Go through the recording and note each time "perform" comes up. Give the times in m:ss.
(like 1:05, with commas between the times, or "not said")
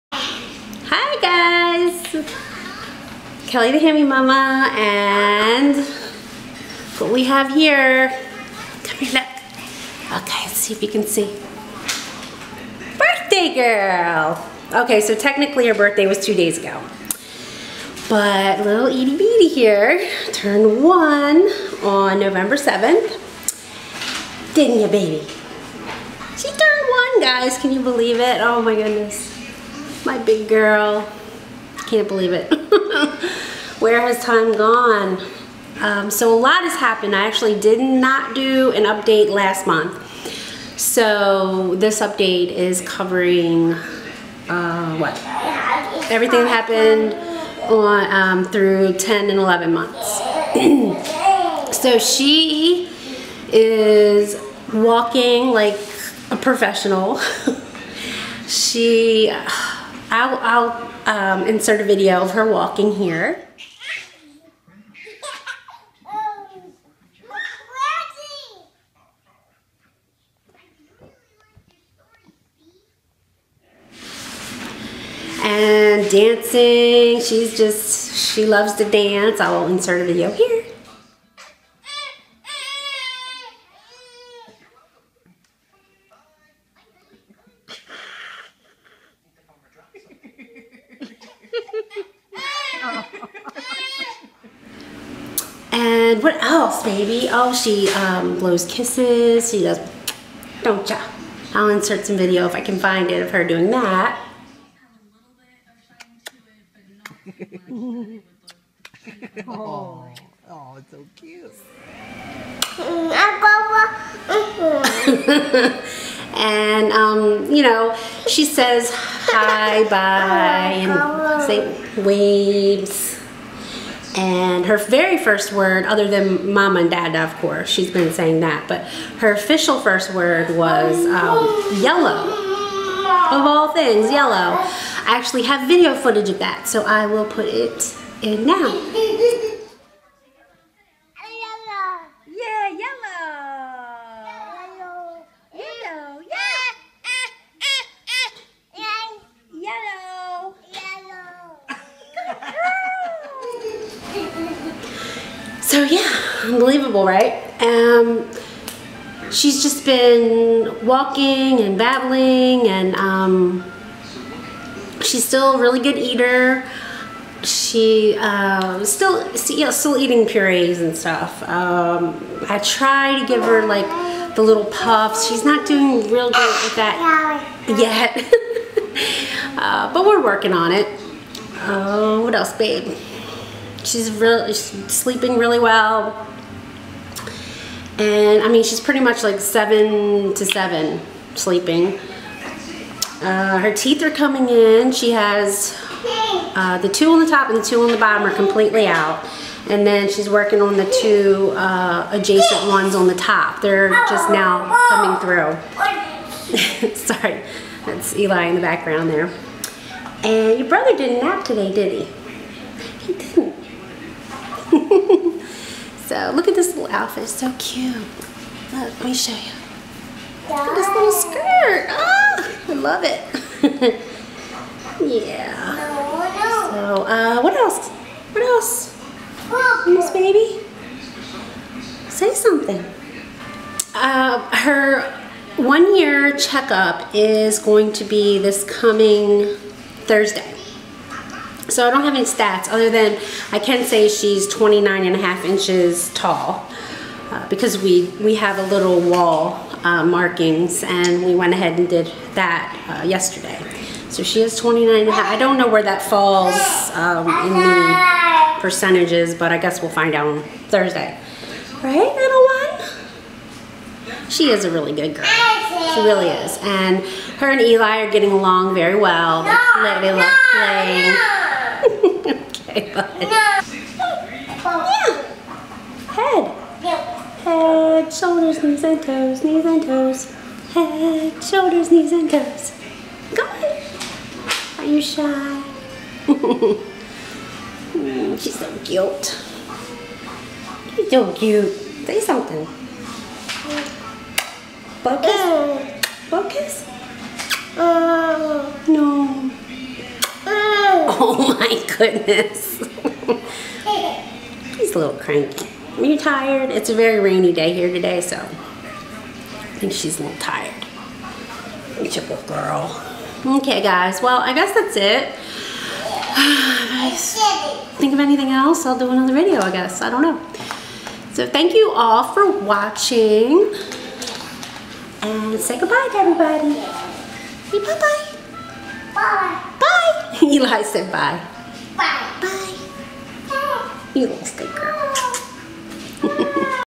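not said.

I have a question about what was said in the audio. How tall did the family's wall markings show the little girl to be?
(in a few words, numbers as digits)
29 and a half inches.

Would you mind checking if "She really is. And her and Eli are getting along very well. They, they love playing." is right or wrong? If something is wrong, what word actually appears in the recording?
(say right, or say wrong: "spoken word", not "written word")
right.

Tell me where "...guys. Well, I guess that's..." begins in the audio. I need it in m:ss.
5:13.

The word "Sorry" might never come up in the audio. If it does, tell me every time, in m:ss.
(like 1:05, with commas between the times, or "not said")
3:26.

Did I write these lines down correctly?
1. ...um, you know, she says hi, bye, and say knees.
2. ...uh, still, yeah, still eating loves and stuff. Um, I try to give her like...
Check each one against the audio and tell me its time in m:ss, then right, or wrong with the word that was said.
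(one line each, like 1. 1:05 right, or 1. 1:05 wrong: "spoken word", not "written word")
1. 1:56 wrong: "waves", not "knees"
2. 2:48 wrong: "purees", not "loves".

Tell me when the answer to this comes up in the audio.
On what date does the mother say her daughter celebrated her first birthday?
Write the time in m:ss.
0:22.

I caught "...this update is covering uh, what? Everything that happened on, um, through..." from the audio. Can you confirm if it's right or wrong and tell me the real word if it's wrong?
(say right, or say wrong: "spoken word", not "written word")
right.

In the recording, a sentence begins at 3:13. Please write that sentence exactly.
Uh, her teeth are coming in.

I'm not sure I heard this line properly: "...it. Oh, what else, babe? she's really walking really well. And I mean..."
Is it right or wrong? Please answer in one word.
wrong.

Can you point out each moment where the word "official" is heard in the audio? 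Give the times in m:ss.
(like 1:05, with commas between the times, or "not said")
2:09.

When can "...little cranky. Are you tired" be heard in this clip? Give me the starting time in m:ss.
5:04.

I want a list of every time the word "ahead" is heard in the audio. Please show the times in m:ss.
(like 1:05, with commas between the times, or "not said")
4:11, 4:43.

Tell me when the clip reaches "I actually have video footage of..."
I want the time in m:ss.
2:14.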